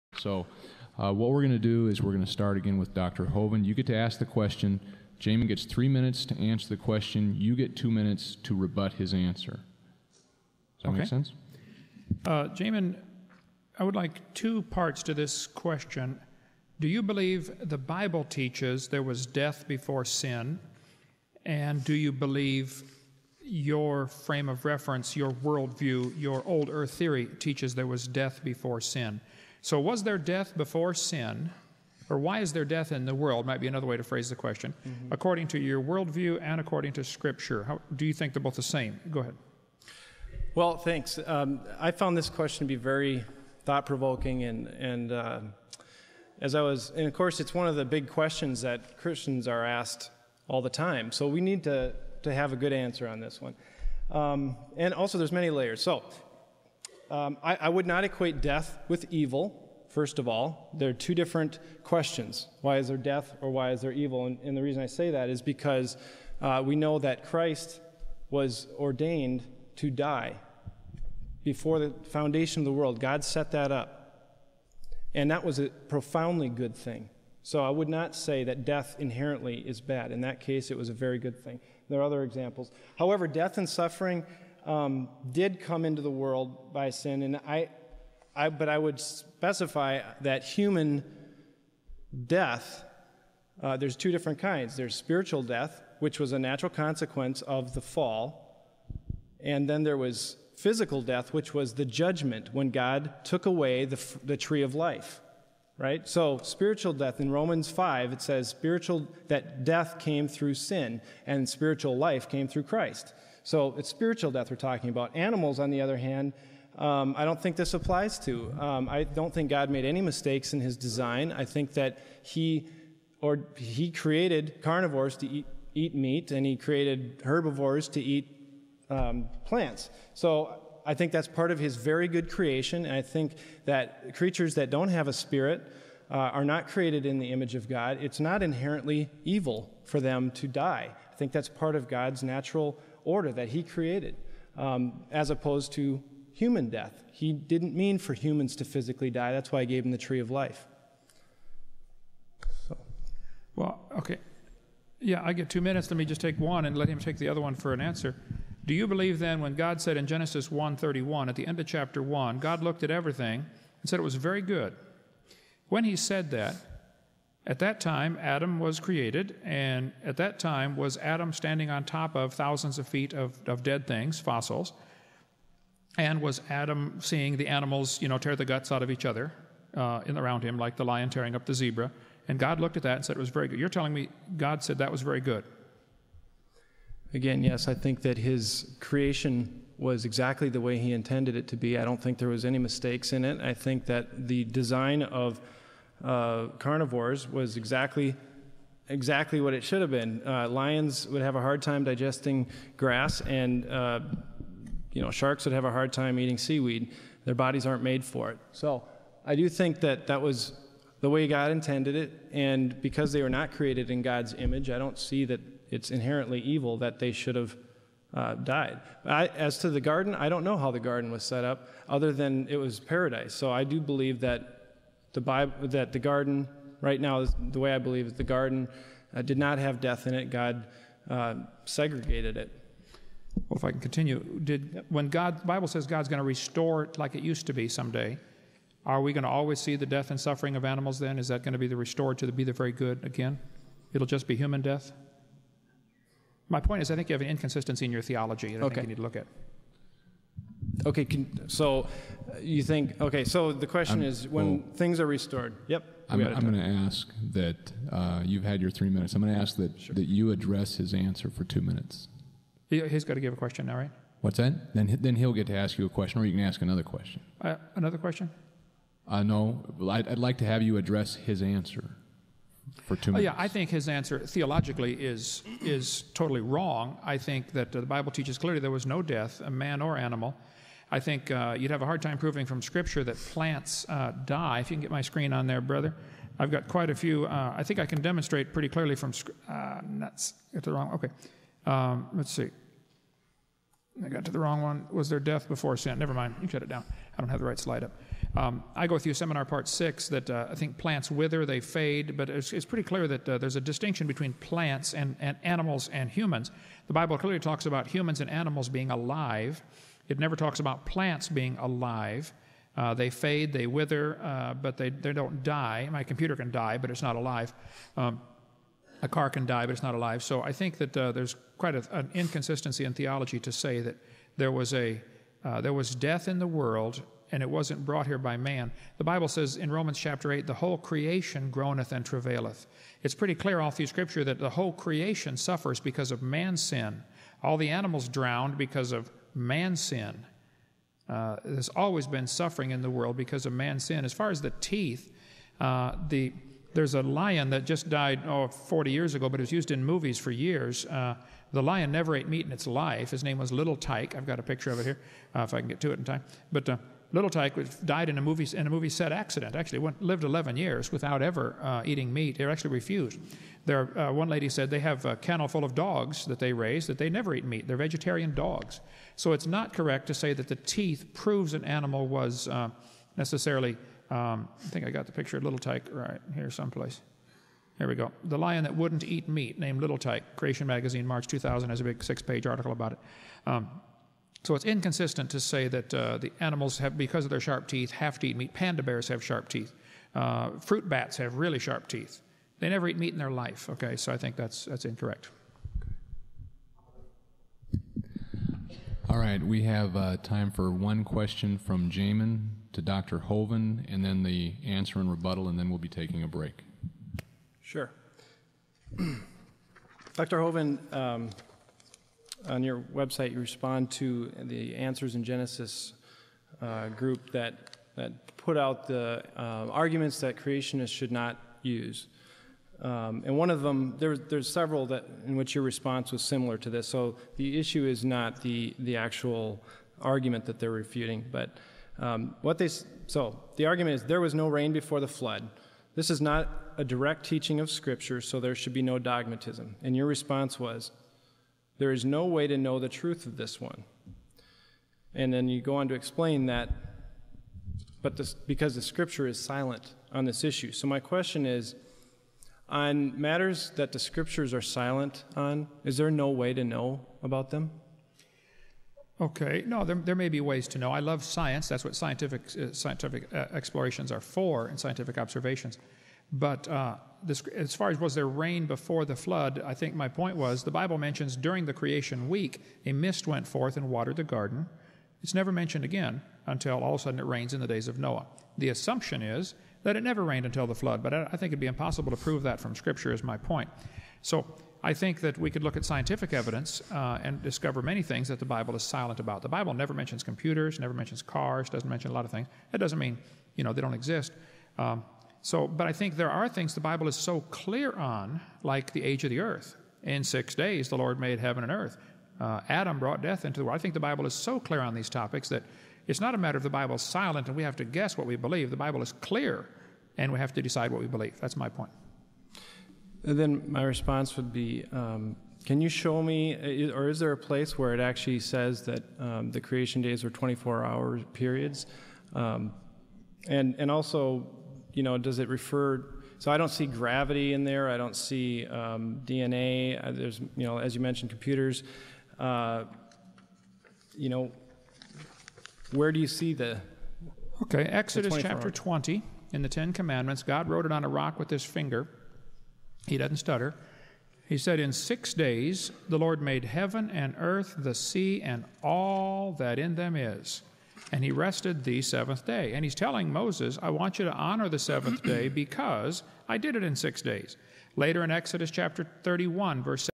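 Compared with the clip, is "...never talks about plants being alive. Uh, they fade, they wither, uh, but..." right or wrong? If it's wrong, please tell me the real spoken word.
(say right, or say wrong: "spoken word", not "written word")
right.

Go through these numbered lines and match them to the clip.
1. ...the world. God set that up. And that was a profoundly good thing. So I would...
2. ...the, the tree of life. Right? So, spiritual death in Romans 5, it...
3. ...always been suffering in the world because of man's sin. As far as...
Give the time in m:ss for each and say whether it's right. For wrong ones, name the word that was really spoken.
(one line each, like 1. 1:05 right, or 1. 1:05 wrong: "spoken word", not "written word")
1. 1:12 right
2. 1:43 right
3. 5:41 right.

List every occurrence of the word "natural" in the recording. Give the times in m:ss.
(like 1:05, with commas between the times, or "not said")
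1:36, 2:22.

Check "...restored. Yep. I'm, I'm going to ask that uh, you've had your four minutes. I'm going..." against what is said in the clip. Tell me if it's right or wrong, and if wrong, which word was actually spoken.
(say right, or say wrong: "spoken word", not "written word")
wrong: "three", not "four".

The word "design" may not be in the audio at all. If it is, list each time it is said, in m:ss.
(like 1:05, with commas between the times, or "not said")
2:00, 3:14.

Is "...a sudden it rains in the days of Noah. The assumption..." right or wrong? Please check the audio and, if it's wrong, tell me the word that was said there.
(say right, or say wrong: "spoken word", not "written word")
right.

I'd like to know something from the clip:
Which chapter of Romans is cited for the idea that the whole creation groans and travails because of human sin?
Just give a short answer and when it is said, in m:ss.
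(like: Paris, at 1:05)
Chapter 8, at 5:29.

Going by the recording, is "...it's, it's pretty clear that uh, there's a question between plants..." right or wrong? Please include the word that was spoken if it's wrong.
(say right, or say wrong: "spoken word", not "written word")
wrong: "distinction", not "question".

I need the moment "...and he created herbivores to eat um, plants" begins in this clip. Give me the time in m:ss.
2:06.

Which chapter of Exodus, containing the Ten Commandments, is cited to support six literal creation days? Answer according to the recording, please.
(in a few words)
Chapter 20.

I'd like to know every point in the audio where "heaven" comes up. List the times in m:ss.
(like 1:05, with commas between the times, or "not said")
8:21, 9:06.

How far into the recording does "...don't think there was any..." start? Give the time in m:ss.
3:11.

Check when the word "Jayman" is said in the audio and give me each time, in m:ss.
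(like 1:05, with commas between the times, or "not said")
0:05, 0:12.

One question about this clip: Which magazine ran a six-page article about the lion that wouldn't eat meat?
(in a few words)
Creation Magazine.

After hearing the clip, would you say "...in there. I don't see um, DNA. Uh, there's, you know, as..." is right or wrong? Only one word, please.
right.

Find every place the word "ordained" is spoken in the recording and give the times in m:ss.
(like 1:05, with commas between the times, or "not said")
1:08.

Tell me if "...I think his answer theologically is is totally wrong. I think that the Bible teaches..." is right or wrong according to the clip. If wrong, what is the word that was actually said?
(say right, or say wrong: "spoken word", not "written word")
right.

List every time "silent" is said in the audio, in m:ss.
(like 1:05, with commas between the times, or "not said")
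7:29, 7:34, 8:08, 8:27.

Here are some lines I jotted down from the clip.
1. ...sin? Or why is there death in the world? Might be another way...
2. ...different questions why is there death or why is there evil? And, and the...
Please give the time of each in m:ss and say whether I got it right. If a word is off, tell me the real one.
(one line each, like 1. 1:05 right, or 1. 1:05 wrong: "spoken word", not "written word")
1. 0:30 right
2. 1:01 right.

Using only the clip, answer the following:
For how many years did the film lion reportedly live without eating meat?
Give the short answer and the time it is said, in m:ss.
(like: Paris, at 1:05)
11, at 6:00.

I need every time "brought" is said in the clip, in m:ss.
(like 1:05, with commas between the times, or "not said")
5:27, 8:22.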